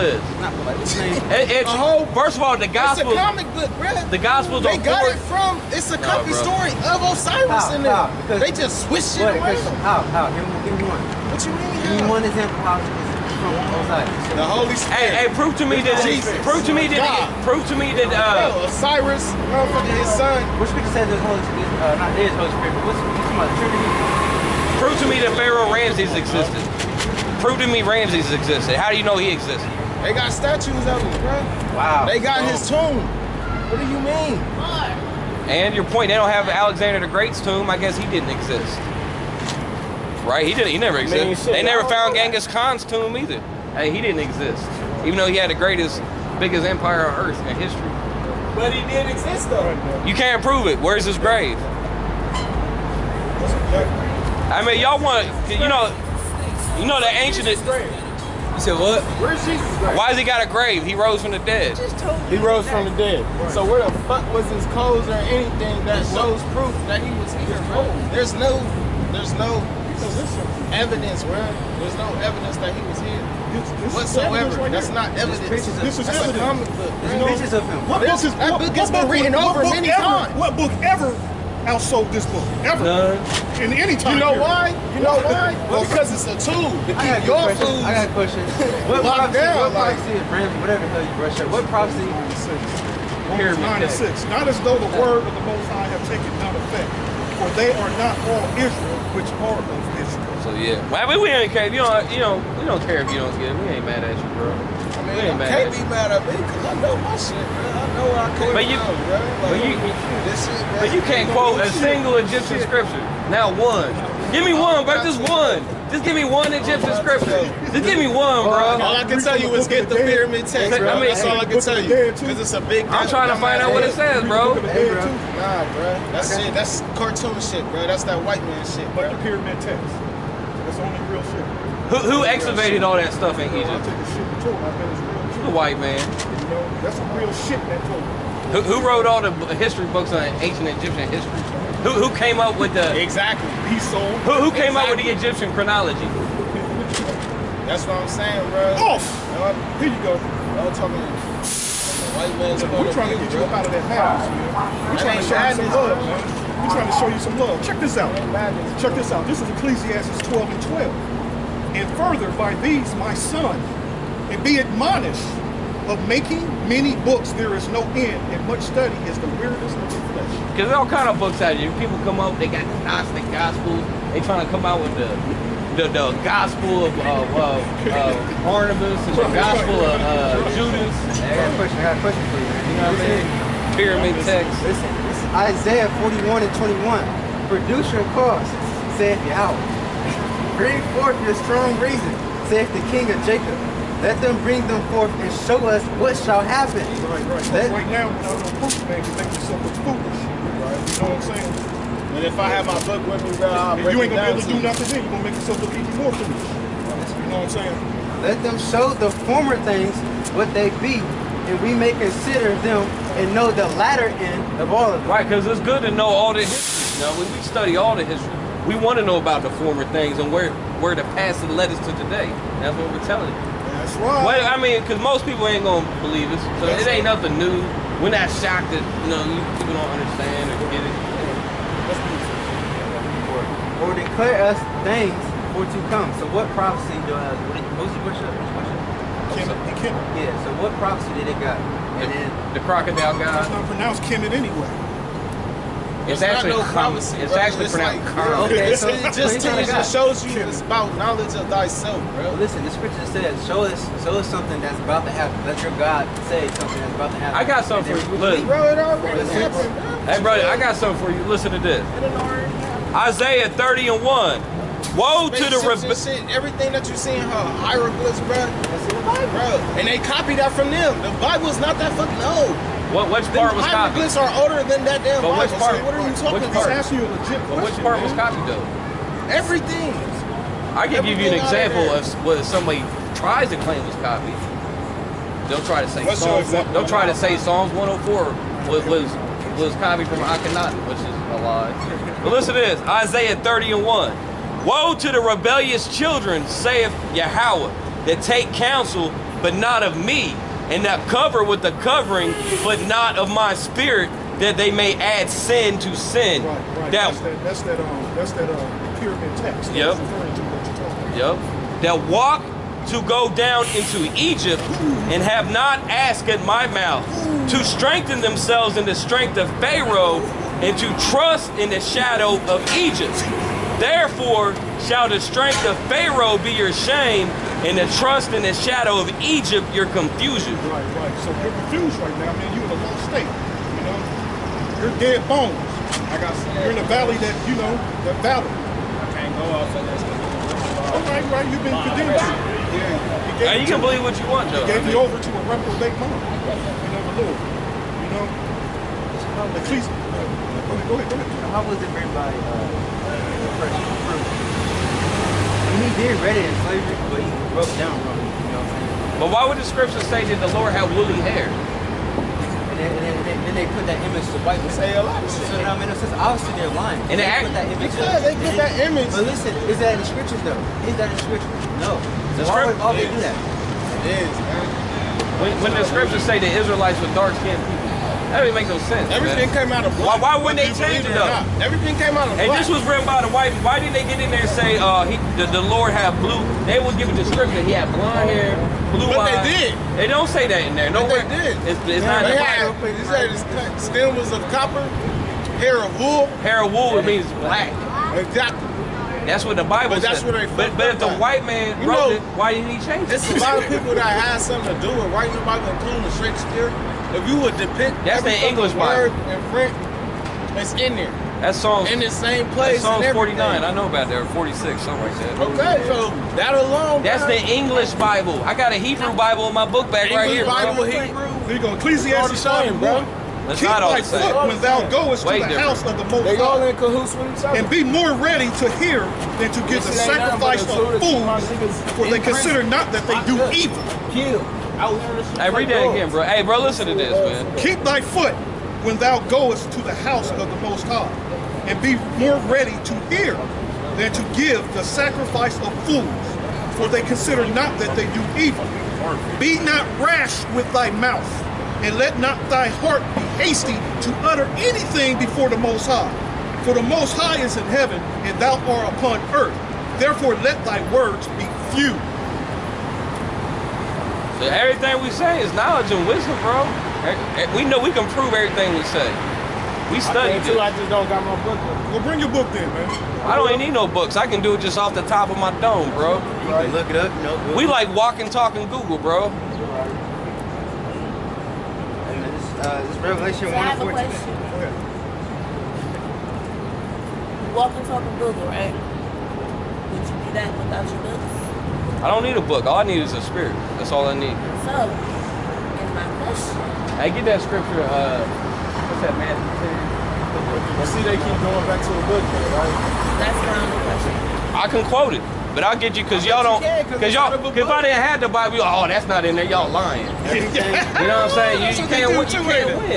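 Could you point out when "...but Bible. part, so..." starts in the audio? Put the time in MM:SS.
04:35.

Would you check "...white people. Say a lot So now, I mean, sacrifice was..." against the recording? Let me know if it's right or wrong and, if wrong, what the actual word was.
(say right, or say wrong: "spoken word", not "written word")
wrong: "since", not "sacrifice".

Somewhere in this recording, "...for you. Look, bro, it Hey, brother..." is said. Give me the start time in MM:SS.
04:17.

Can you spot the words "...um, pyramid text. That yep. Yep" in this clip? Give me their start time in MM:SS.
05:08.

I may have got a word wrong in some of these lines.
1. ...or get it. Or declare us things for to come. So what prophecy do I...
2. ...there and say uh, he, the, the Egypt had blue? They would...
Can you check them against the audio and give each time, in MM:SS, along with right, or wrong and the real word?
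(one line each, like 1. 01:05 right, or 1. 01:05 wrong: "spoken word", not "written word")
1. 03:50 right
2. 06:24 wrong: "Lord", not "Egypt".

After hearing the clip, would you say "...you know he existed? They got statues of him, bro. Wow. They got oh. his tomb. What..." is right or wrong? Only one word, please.
right.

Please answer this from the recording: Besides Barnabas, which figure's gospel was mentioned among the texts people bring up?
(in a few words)
Judas.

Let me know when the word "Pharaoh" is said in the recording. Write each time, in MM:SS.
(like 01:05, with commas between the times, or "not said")
00:25, 05:19, 05:25.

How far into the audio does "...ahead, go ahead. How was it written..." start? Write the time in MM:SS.
05:50.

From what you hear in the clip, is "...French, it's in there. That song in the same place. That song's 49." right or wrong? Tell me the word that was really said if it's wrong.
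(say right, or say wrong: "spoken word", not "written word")
right.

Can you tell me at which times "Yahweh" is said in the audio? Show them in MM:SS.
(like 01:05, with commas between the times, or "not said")
03:09, 04:57.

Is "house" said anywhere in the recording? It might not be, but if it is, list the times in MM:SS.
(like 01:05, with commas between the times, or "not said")
02:34, 07:05, 07:19.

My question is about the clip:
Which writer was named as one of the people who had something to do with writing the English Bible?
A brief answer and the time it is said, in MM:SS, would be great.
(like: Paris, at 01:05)
Shakespeare, at 06:46.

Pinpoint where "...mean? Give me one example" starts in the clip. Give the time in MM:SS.
00:11.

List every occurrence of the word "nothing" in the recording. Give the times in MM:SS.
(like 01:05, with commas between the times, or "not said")
03:24, 03:47.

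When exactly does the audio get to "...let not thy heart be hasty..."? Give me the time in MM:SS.
07:31.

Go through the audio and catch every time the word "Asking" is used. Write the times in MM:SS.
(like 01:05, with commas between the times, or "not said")
04:36.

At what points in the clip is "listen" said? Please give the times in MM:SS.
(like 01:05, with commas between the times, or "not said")
03:04, 04:12, 04:21, 04:52, 06:09, 07:16.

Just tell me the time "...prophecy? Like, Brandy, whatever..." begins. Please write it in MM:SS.
01:29.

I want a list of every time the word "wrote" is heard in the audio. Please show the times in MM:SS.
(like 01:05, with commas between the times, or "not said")
02:18, 06:41.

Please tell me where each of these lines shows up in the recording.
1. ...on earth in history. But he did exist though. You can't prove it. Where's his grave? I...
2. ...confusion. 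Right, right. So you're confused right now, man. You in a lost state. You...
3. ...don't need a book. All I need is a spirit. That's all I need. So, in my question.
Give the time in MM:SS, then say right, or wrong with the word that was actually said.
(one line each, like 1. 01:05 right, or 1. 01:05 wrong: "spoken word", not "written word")
1. 00:47 right
2. 05:29 right
3. 08:12 right.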